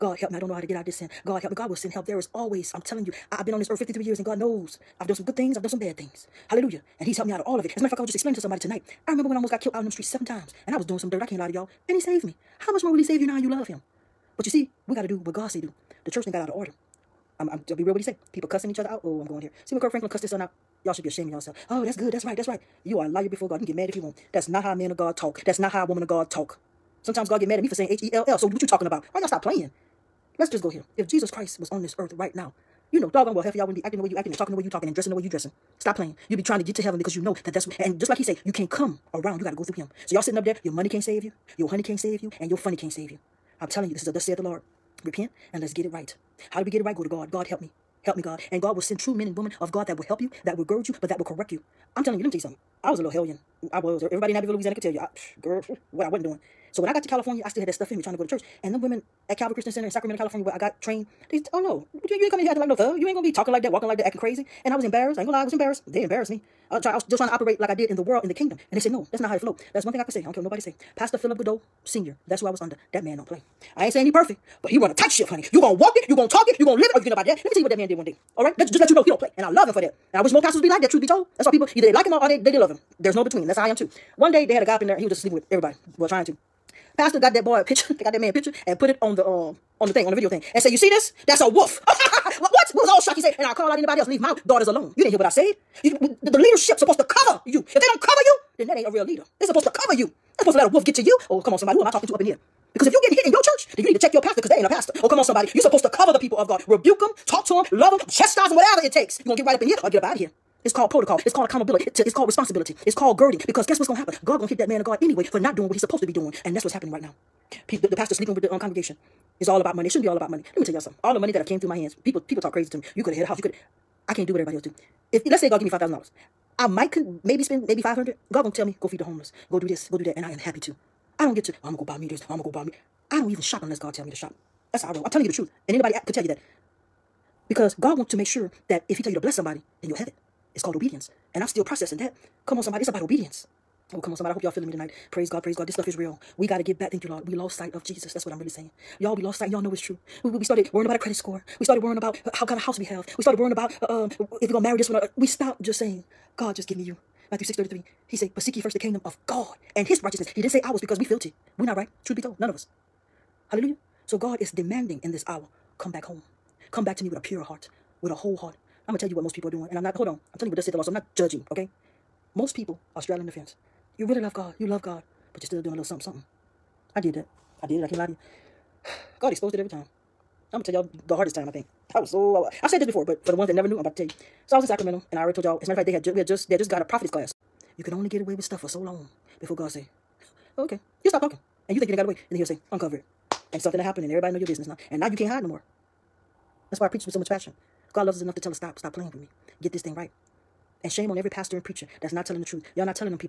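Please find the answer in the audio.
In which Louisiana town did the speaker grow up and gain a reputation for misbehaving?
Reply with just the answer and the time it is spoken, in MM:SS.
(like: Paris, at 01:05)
Abbeville, at 00:54.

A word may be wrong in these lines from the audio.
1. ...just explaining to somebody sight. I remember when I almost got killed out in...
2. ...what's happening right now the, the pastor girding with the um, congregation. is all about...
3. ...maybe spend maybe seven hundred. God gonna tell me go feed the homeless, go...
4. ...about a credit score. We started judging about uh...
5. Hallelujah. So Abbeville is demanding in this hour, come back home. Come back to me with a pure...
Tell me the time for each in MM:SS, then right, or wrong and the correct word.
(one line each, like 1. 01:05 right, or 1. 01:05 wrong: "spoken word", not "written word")
1. 00:08 wrong: "tonight", not "sight"
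2. 01:56 wrong: "sleeping", not "girding"
3. 02:07 wrong: "five", not "seven"
4. 02:30 wrong: "worrying", not "judging"
5. 02:43 wrong: "God", not "Abbeville".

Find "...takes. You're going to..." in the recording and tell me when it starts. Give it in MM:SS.
01:48.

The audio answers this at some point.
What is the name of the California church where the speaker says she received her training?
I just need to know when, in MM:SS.
00:59.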